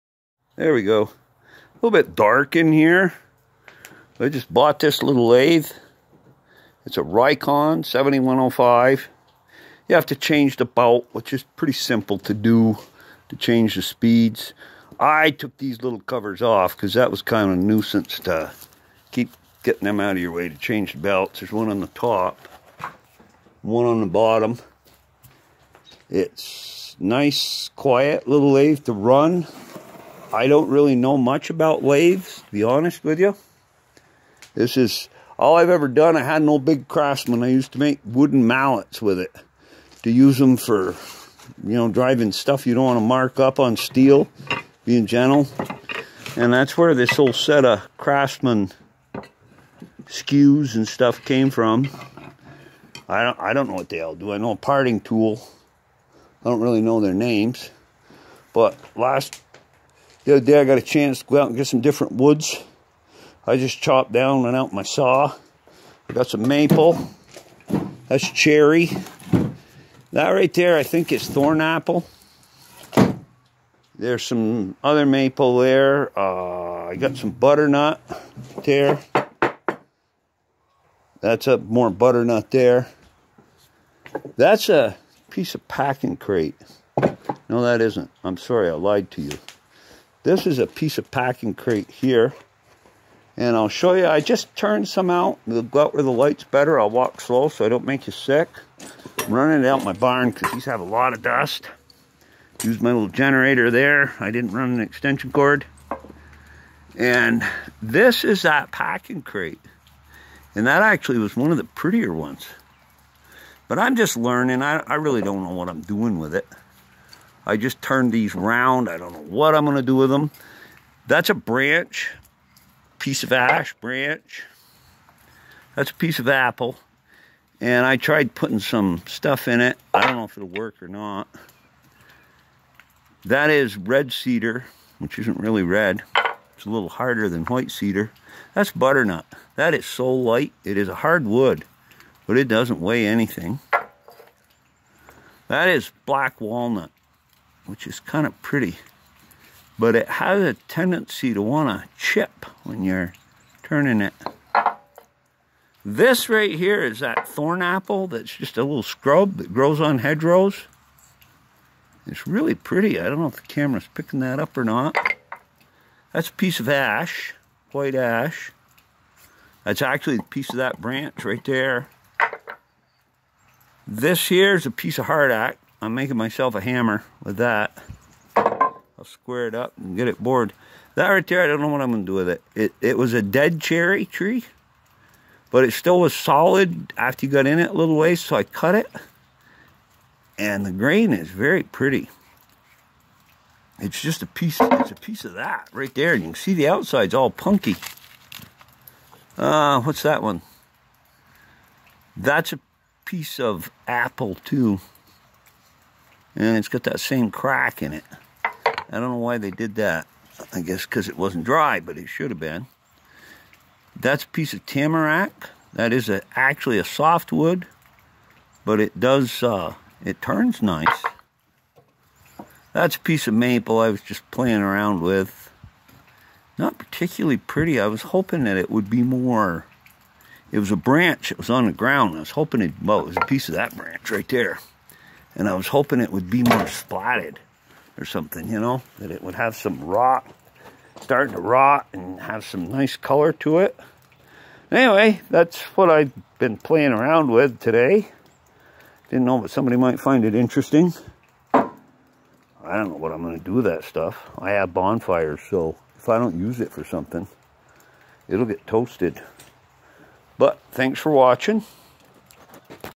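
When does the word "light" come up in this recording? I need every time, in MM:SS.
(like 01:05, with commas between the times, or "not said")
01:36, 02:20.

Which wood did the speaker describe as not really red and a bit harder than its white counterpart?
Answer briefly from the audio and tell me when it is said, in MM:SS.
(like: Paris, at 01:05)
red cedar, at 02:13.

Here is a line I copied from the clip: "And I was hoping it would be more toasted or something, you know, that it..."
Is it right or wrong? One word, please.
wrong.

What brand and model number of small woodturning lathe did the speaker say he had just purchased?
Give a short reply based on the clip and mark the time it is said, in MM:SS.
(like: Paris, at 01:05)
Rikon 7105, at 00:07.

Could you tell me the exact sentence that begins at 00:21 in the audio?
There's one on the top, one on the bottom.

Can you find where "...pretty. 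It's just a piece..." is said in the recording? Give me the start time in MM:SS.
03:11.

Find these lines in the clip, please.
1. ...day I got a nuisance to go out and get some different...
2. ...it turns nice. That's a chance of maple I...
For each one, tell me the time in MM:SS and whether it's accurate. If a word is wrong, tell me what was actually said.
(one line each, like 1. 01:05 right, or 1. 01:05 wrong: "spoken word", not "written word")
1. 01:00 wrong: "chance", not "nuisance"
2. 03:40 wrong: "piece", not "chance".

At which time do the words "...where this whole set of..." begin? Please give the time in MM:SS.
00:46.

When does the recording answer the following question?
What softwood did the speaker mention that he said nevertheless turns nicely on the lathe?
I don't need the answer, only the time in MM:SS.
03:34.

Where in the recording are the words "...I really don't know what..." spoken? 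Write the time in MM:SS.
01:54.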